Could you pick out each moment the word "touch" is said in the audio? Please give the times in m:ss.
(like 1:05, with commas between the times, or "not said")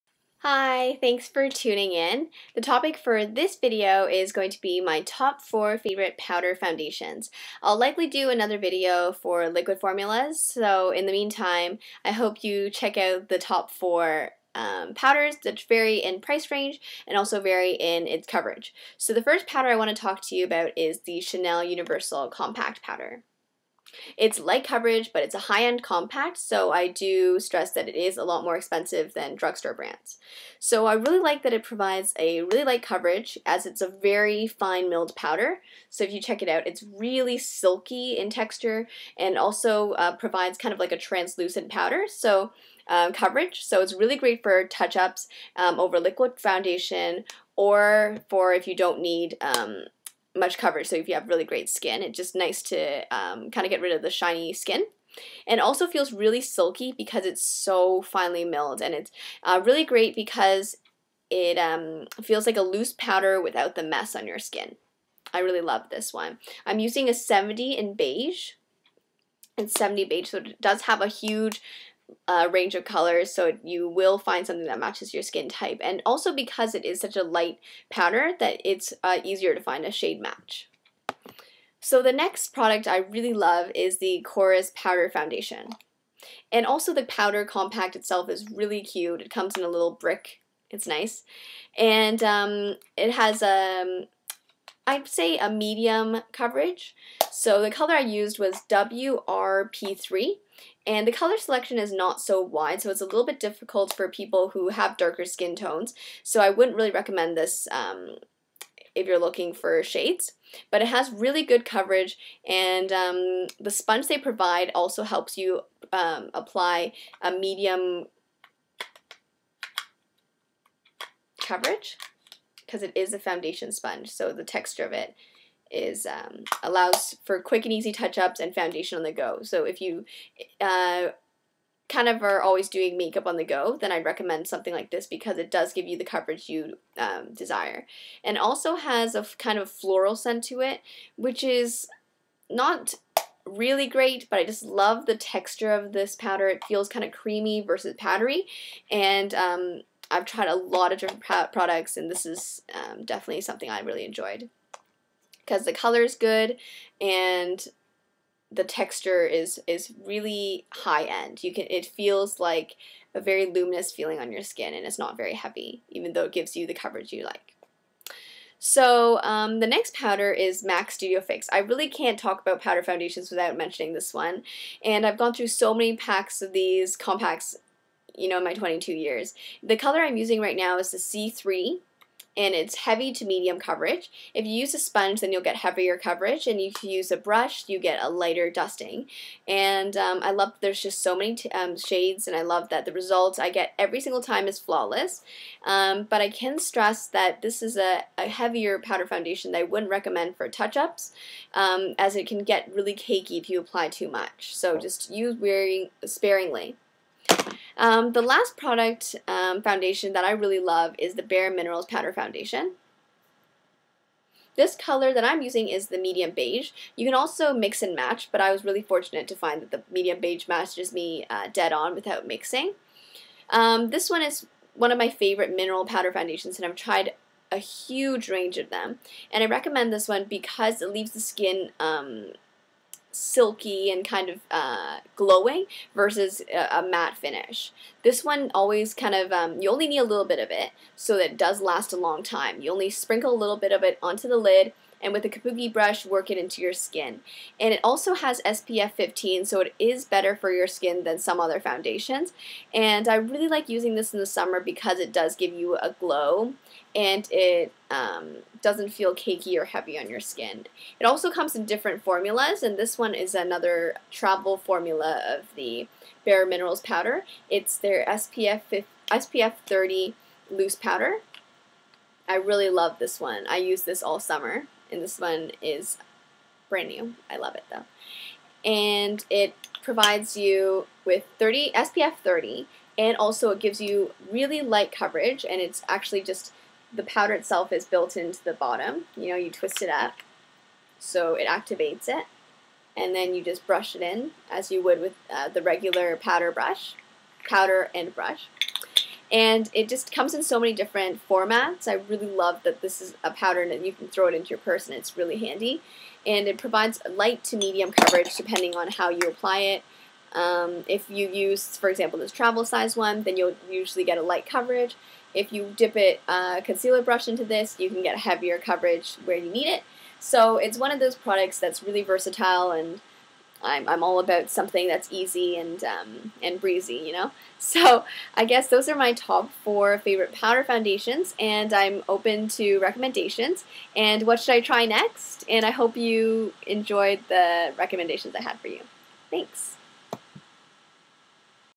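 0:44, 2:07, 3:20.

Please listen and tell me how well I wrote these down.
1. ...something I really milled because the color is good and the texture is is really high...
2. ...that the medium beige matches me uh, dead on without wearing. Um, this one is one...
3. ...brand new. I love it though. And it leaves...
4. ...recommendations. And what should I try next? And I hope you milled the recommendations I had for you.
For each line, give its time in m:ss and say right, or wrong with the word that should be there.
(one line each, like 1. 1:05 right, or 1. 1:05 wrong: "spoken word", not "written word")
1. 2:33 wrong: "enjoyed", not "milled"
2. 3:39 wrong: "mixing", not "wearing"
3. 4:36 wrong: "provides", not "leaves"
4. 5:32 wrong: "enjoyed", not "milled".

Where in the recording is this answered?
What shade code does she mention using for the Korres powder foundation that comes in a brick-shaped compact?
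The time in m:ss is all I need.
1:38.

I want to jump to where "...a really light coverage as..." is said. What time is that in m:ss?
0:32.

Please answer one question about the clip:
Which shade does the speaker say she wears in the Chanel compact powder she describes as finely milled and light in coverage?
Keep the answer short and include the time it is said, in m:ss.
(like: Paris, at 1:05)
70 Beige, at 1:09.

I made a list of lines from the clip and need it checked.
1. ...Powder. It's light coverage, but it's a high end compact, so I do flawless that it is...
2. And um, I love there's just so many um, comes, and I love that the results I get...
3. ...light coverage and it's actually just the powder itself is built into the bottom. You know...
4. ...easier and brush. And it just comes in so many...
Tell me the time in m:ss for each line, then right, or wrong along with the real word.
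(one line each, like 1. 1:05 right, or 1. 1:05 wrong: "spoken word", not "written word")
1. 0:22 wrong: "stress", not "flawless"
2. 3:09 wrong: "shades", not "comes"
3. 4:44 right
4. 4:57 wrong: "powder", not "easier".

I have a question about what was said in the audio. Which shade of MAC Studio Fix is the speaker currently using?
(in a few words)
C3.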